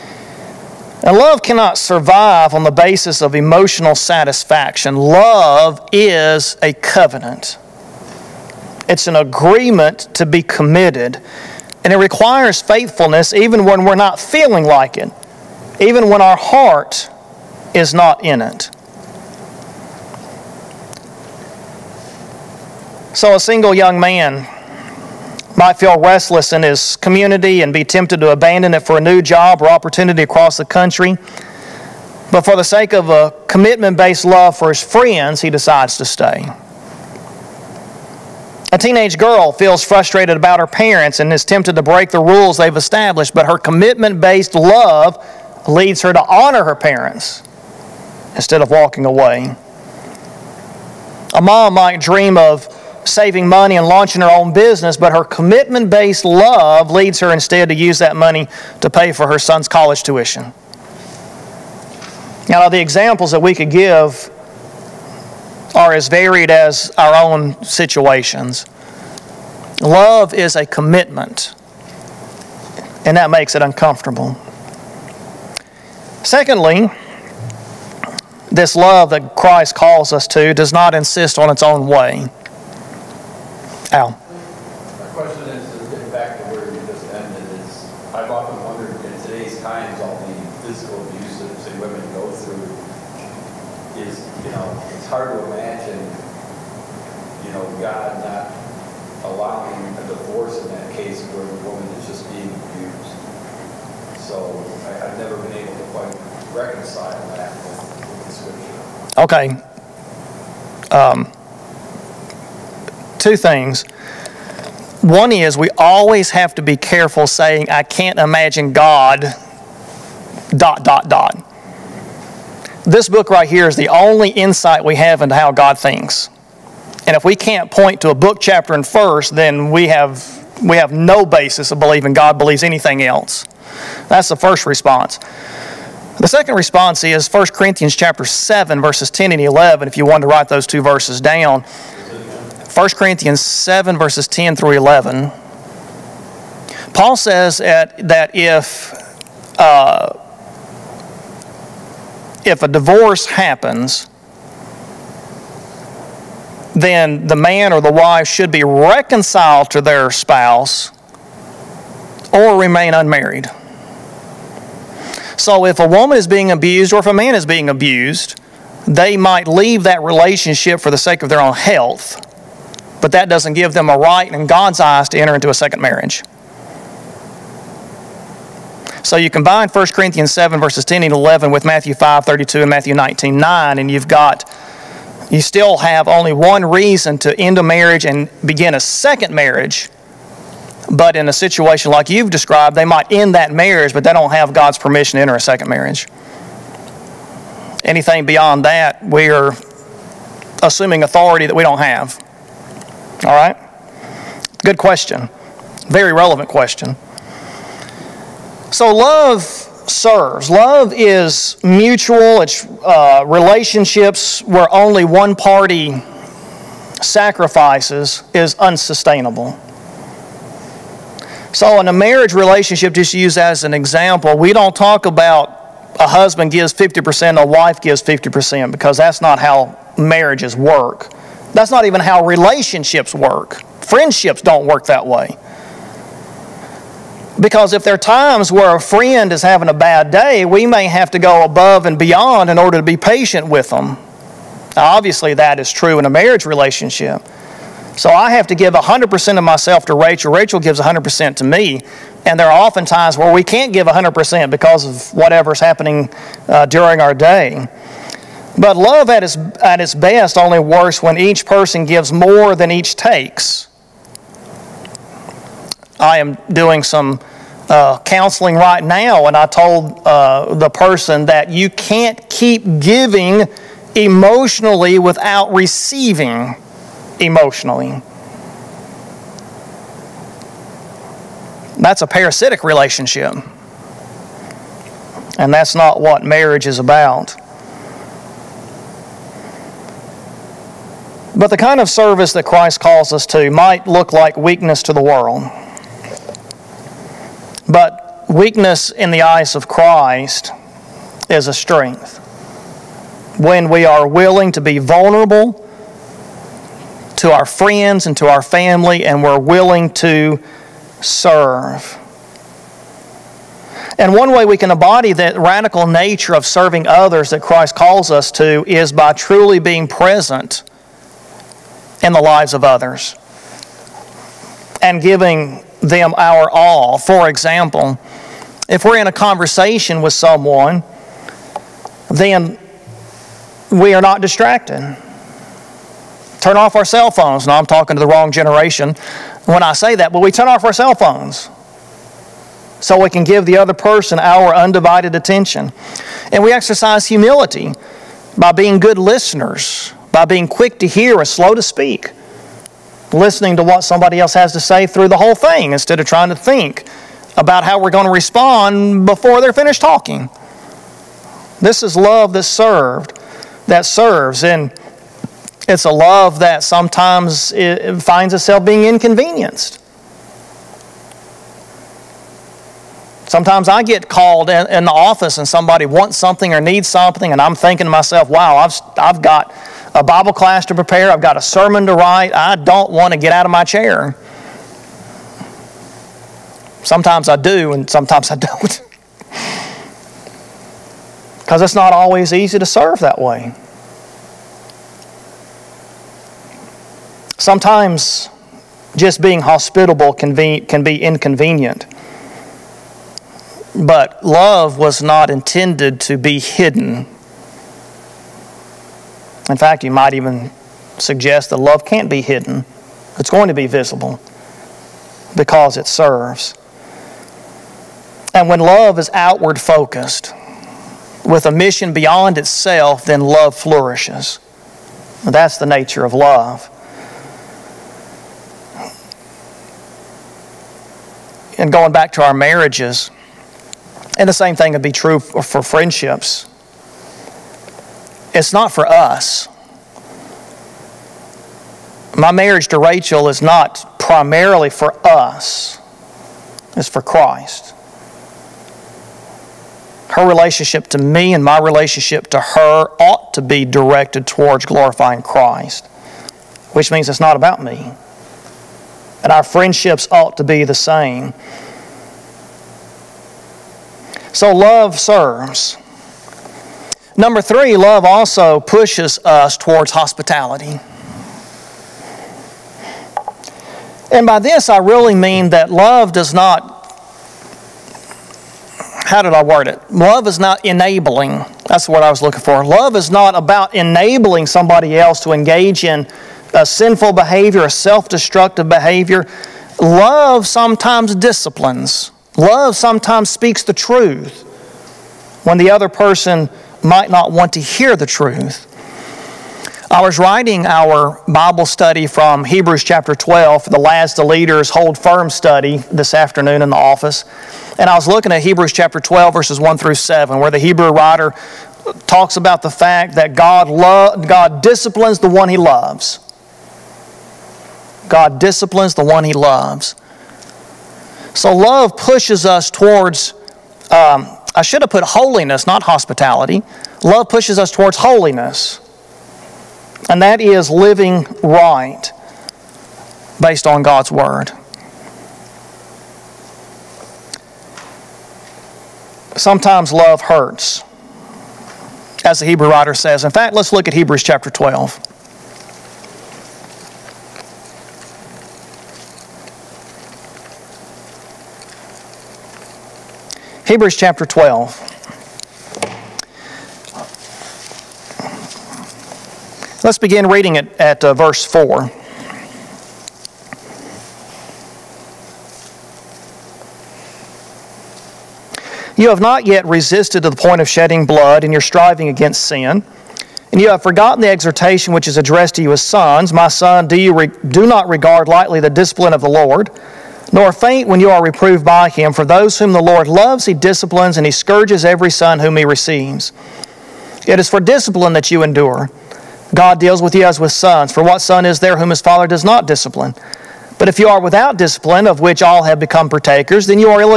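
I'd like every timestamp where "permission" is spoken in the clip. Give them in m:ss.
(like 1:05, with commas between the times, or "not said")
3:14.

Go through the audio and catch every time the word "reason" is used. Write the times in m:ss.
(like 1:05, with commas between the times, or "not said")
3:06.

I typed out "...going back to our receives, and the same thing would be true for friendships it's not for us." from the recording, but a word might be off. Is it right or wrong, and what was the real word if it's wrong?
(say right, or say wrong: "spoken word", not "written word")
wrong: "marriages", not "receives".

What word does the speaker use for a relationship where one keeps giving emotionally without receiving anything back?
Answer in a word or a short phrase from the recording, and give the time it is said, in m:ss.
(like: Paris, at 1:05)
Parasitic, at 4:42.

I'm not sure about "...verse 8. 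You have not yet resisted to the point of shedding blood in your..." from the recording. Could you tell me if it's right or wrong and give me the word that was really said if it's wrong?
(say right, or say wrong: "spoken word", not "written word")
wrong: "4", not "8".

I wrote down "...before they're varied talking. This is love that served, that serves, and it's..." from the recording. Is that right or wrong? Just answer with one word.
wrong.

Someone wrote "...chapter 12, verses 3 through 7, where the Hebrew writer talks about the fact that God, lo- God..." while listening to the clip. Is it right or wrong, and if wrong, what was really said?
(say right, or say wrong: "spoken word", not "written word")
wrong: "1", not "3".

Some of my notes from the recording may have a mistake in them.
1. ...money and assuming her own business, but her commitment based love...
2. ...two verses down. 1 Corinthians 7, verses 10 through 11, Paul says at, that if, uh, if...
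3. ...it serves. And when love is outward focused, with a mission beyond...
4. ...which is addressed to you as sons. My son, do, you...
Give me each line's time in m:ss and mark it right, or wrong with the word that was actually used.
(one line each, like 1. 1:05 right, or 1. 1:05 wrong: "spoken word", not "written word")
1. 0:53 wrong: "launching", not "assuming"
2. 2:20 right
3. 6:55 right
4. 9:34 right.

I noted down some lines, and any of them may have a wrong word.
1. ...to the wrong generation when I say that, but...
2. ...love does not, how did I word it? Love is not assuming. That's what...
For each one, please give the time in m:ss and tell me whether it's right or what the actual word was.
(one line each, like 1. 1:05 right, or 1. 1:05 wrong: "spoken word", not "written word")
1. 5:37 right
2. 7:55 wrong: "enabling", not "assuming".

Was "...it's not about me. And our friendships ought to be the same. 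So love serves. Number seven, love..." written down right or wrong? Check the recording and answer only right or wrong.
wrong.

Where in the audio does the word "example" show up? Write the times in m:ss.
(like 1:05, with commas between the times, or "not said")
1:02, 3:43, 5:27.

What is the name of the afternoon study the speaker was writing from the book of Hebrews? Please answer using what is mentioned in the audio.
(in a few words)
Last the Leaders Hold Firm.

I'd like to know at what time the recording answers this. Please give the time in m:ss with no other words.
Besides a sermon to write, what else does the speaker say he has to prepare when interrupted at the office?
6:20.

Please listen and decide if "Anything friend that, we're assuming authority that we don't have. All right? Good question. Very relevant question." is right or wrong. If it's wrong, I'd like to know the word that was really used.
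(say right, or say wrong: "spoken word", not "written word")
wrong: "beyond", not "friend".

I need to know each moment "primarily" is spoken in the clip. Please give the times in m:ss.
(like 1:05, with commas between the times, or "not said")
7:23.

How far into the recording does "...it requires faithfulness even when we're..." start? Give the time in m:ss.
0:11.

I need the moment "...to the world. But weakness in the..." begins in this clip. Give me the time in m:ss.
4:54.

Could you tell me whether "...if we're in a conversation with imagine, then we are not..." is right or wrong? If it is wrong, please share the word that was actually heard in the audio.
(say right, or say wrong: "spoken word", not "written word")
wrong: "someone", not "imagine".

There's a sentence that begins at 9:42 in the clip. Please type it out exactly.
For those whom the Lord loves, he disciplines, and he scourges every son whom he receives.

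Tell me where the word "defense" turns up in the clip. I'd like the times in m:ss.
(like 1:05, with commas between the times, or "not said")
not said.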